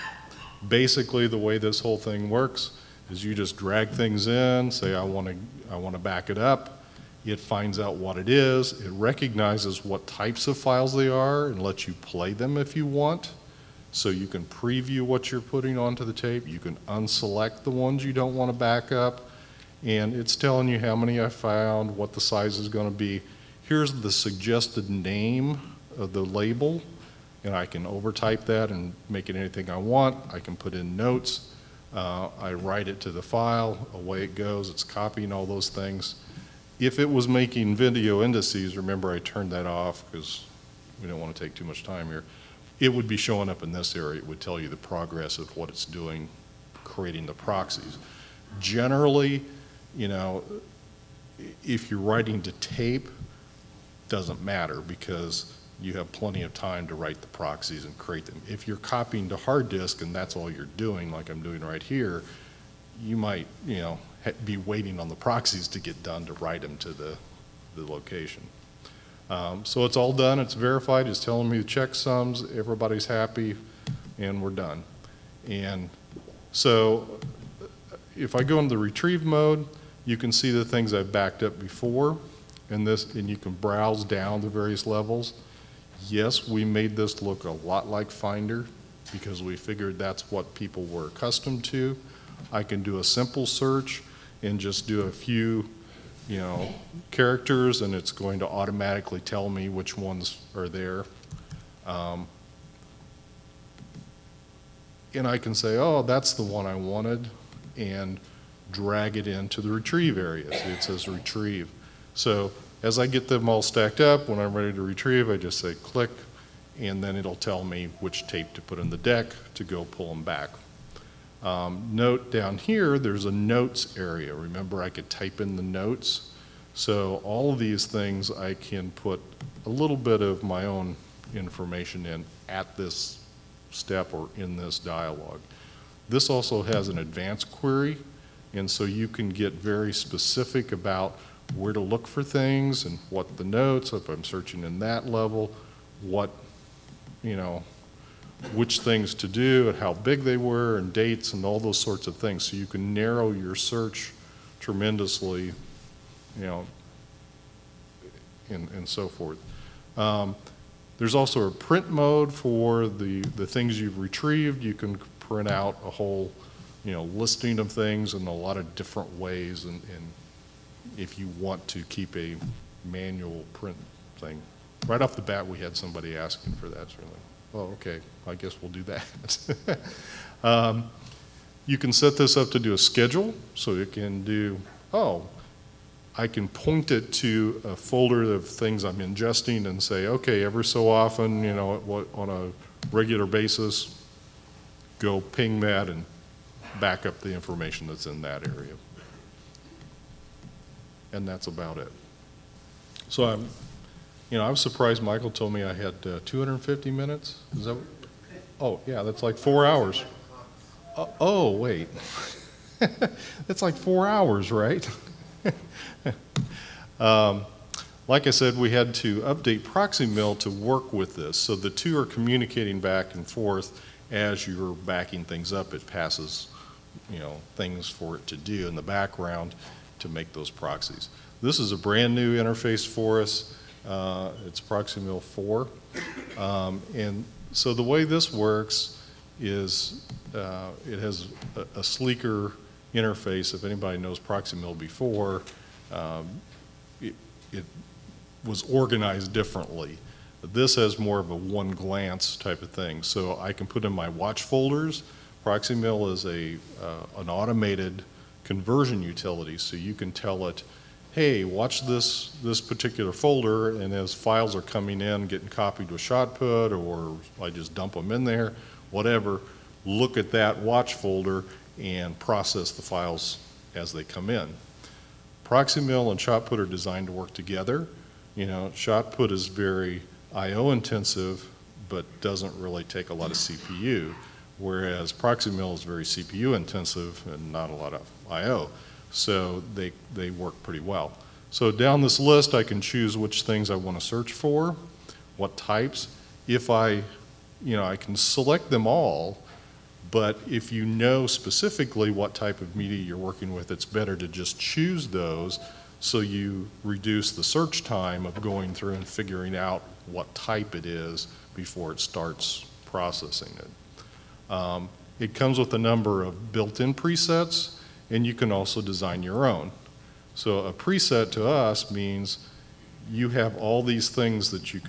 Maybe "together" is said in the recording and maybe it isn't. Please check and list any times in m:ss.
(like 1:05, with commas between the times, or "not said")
4:37.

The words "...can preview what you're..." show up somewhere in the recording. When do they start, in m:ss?
0:14.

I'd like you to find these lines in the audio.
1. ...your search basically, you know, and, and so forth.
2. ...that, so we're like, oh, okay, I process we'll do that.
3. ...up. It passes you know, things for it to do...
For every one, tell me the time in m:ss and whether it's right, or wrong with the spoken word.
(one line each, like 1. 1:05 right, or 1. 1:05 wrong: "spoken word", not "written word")
1. 2:33 wrong: "tremendously", not "basically"
2. 2:56 wrong: "guess", not "process"
3. 3:45 right.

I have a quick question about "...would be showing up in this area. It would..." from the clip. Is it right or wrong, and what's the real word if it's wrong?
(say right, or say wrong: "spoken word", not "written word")
right.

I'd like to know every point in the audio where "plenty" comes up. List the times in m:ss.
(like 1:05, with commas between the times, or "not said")
0:56.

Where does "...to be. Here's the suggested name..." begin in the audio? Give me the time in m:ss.
0:22.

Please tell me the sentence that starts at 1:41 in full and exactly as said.
Um, and I can say, oh, that's the one I wanted.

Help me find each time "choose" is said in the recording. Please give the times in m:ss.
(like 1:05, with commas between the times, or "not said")
4:52, 5:04.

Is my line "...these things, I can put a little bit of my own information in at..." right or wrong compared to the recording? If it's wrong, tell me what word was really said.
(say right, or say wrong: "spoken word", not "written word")
right.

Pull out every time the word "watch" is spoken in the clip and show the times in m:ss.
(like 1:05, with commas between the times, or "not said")
4:14, 4:21, 4:30.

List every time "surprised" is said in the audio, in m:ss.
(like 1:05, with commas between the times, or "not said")
3:24.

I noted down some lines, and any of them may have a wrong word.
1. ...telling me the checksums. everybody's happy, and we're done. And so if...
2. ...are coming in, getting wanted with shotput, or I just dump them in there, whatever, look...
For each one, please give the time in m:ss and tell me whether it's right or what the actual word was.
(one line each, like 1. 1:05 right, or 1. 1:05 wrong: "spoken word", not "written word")
1. 1:11 right
2. 4:24 wrong: "copied", not "wanted".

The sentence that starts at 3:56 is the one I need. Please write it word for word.
Um, and so the way this works is uh, it has a, a, sleeker interface.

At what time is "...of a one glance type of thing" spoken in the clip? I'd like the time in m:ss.
4:11.